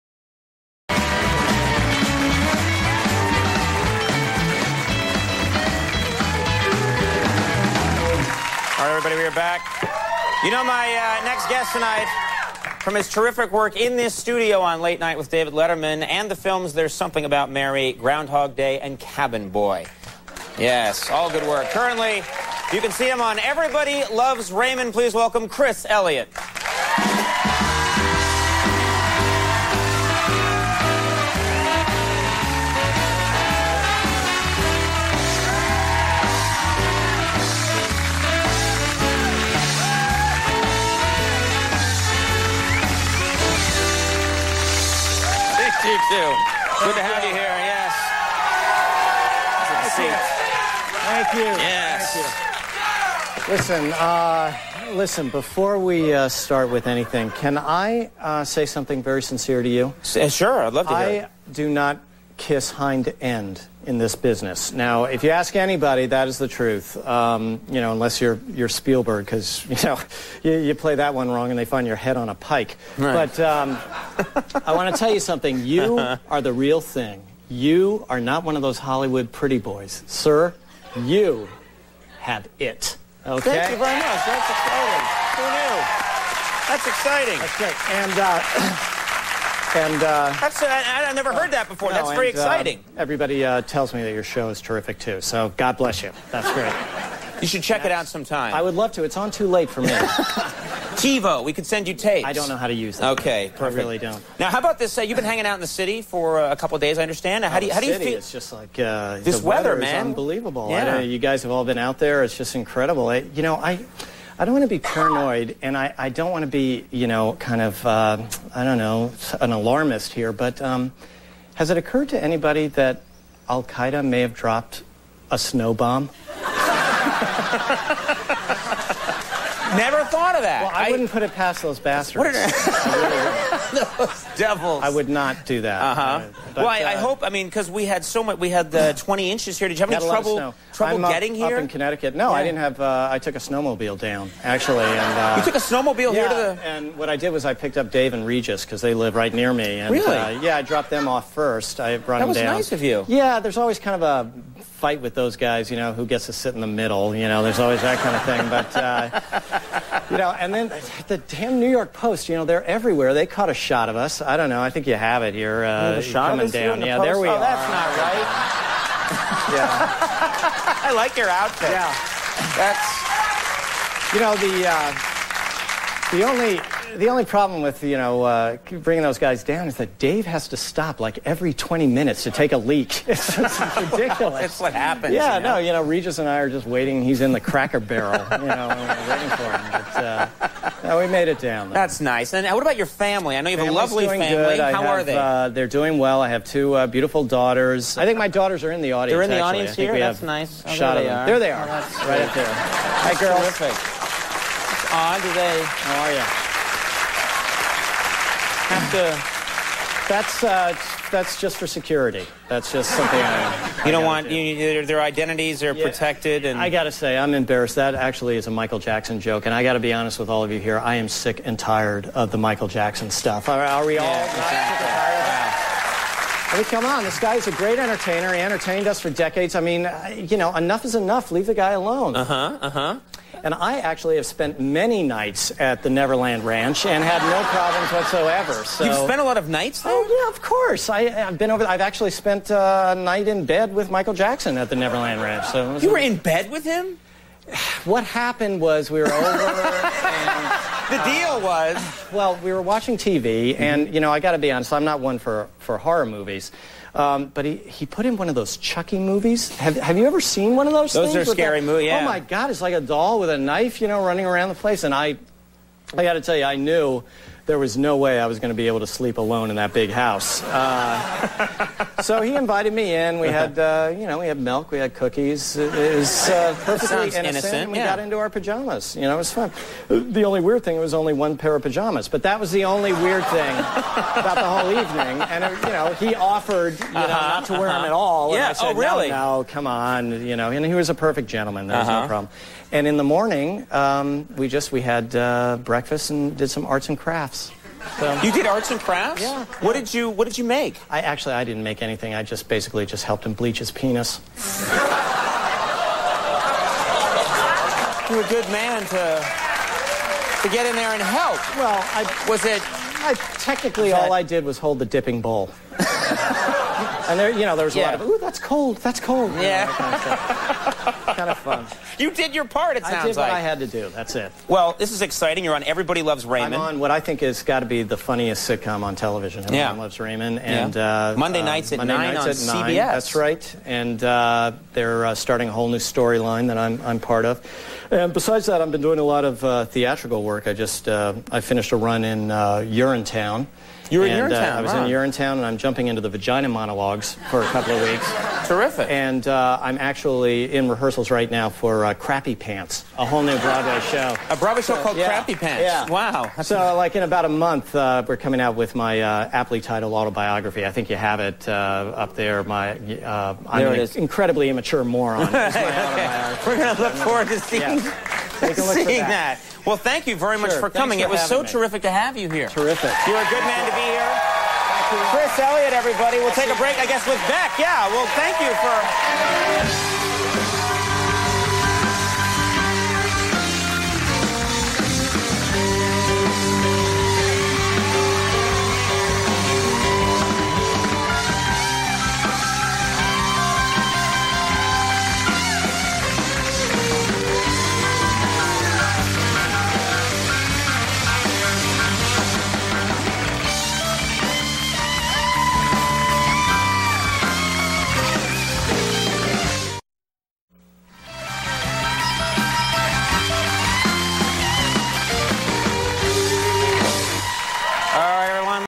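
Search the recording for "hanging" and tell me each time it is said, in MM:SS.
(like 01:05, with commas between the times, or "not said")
01:45.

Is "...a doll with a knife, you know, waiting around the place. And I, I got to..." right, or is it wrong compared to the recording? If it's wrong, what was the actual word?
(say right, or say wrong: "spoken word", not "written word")
wrong: "running", not "waiting".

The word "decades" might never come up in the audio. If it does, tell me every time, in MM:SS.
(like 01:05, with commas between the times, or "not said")
03:49.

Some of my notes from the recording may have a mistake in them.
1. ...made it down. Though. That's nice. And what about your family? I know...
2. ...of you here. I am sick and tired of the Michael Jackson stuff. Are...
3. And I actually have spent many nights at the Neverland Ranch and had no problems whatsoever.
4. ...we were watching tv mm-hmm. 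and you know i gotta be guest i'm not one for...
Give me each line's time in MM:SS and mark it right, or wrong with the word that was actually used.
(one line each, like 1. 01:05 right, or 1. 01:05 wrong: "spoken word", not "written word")
1. 03:11 right
2. 03:40 right
3. 03:53 right
4. 04:12 wrong: "honest", not "guest".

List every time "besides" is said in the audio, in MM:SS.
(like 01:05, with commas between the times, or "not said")
05:38.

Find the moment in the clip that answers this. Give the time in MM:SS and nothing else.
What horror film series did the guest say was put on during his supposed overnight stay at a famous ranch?
04:18.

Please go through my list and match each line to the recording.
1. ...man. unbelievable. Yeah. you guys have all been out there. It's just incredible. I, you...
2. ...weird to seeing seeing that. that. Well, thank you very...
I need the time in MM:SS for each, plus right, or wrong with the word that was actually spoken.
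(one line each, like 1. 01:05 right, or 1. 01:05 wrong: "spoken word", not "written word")
1. 01:49 right
2. 06:06 wrong: "forward", not "weird".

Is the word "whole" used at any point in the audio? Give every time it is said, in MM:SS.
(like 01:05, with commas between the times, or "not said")
04:44, 05:35, 05:53.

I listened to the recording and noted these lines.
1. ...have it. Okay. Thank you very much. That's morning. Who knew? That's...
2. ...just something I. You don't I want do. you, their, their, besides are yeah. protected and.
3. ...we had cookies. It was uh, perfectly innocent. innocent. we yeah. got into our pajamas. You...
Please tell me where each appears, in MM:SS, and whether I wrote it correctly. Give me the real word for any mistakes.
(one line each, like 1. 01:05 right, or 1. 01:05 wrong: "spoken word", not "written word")
1. 01:22 wrong: "exciting", not "morning"
2. 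03:32 wrong: "identities", not "besides"
3. 04:34 right.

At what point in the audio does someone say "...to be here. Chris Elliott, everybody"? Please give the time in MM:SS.
06:13.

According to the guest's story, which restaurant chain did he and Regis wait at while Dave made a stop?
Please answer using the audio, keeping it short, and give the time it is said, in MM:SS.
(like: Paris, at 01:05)
Cracker Barrel, at 03:07.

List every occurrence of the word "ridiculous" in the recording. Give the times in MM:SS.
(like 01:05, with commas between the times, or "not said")
03:03.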